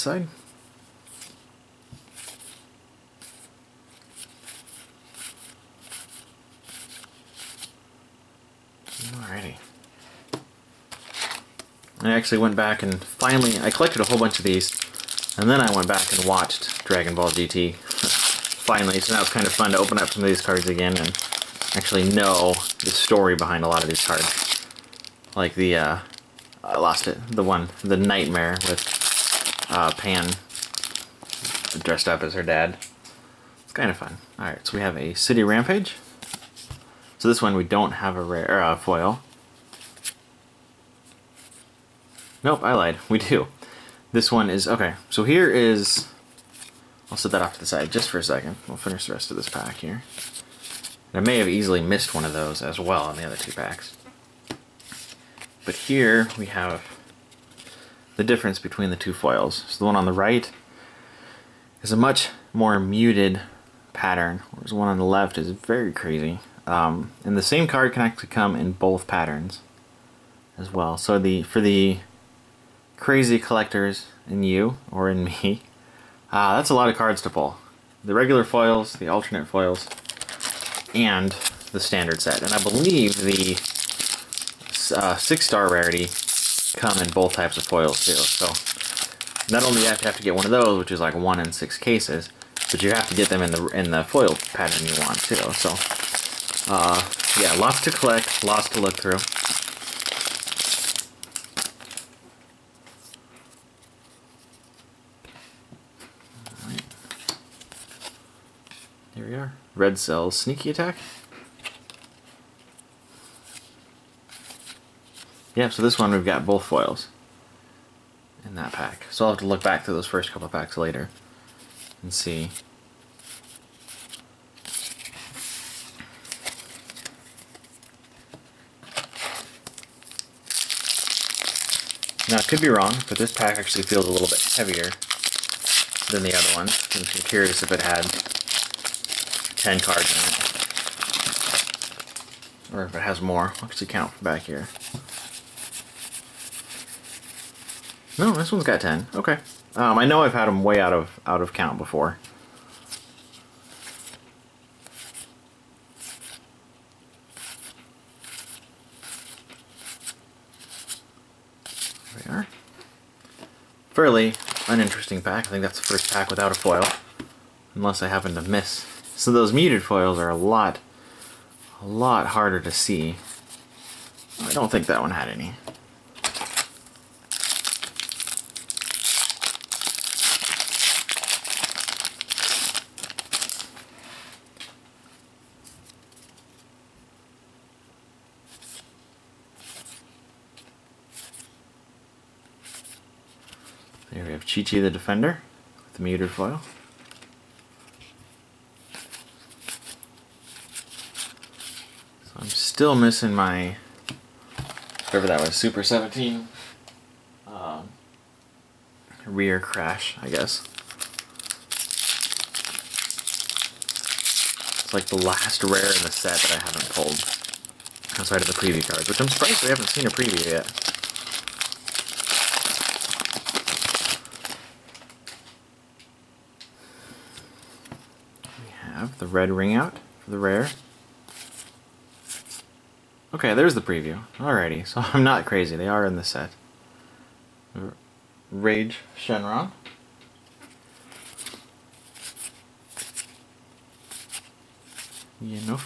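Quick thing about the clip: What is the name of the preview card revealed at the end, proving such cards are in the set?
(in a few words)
Rage Shenron.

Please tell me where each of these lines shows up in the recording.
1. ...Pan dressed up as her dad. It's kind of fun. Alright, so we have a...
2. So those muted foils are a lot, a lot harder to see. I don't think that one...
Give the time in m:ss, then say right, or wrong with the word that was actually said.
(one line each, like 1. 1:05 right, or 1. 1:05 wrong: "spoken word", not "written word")
1. 0:29 right
2. 2:49 right.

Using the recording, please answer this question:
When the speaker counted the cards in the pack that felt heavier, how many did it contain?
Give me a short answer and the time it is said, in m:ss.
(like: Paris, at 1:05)
10, at 2:28.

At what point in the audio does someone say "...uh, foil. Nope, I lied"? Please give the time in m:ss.
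0:38.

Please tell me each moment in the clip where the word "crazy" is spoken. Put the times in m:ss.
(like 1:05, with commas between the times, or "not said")
1:05, 1:12, 3:55.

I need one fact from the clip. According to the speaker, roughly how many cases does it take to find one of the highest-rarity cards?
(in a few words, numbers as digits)
1 in 6.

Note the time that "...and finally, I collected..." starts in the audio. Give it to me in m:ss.
0:12.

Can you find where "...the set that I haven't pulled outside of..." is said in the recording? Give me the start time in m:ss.
3:36.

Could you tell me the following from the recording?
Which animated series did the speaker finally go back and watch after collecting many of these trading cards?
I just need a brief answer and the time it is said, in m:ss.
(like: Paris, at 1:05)
Dragon Ball GT, at 0:16.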